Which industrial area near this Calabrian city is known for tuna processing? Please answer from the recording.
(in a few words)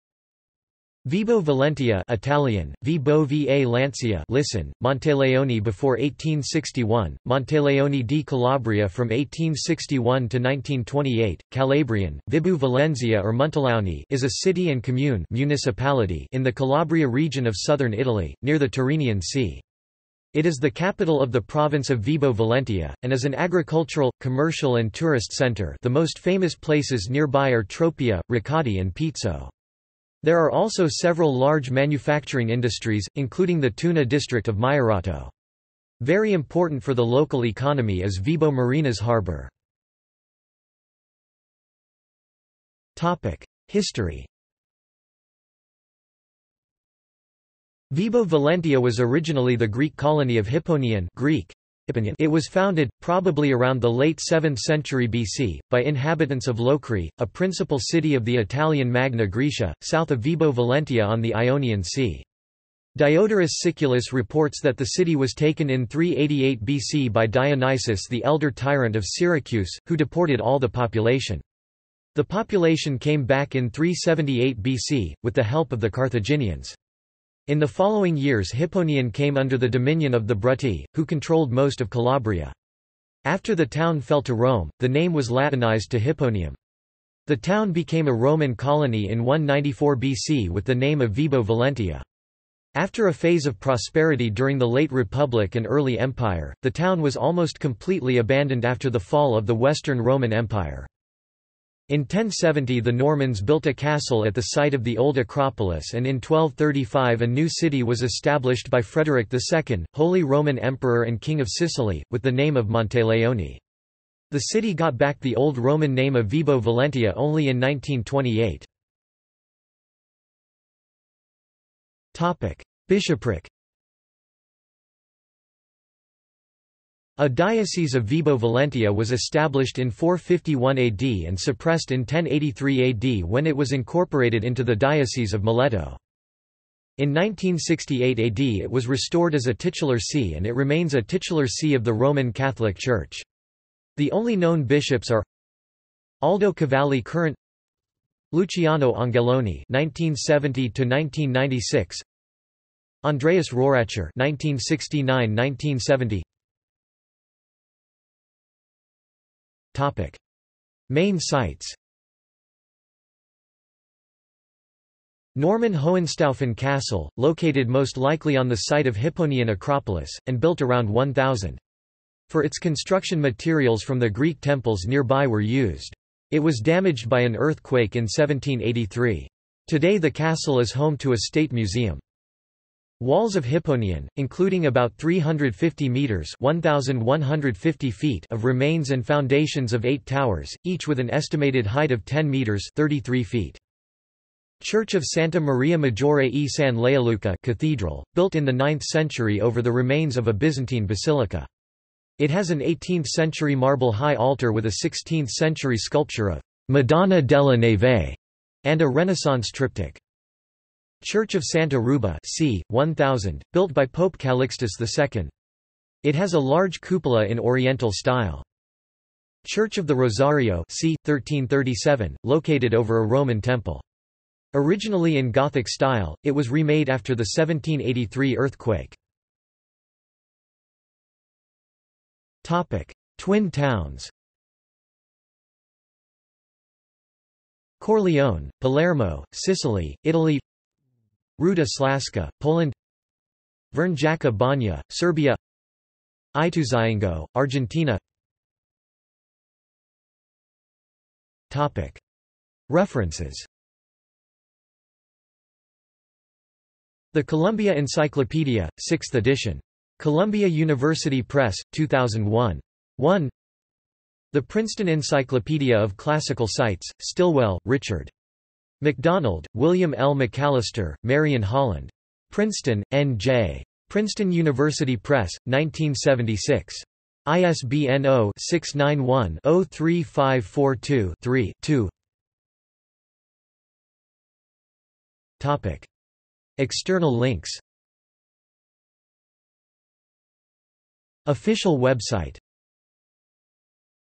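Maierato.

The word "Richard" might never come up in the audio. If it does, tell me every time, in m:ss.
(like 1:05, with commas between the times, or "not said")
4:27.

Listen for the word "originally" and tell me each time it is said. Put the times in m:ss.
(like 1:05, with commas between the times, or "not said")
0:48, 3:44.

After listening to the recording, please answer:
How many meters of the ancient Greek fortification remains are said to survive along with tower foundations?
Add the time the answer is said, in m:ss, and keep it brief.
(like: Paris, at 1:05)
350, at 3:04.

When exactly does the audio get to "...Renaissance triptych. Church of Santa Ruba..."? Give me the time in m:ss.
3:28.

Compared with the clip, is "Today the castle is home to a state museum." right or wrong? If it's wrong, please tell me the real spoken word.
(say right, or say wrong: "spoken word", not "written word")
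right.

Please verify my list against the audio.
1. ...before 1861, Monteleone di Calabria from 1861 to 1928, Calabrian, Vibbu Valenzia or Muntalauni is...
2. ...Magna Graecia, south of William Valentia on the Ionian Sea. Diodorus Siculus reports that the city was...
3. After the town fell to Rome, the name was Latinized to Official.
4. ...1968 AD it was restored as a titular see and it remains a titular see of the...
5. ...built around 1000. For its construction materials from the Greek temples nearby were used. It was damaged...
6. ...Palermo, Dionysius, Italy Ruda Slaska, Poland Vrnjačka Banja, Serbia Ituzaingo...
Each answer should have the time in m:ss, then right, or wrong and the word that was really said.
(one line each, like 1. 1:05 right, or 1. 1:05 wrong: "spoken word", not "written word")
1. 0:05 right
2. 0:58 wrong: "Vibo", not "William"
3. 1:23 wrong: "Hipponium", not "Official"
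4. 2:17 right
5. 2:50 right
6. 3:58 wrong: "Sicily", not "Dionysius".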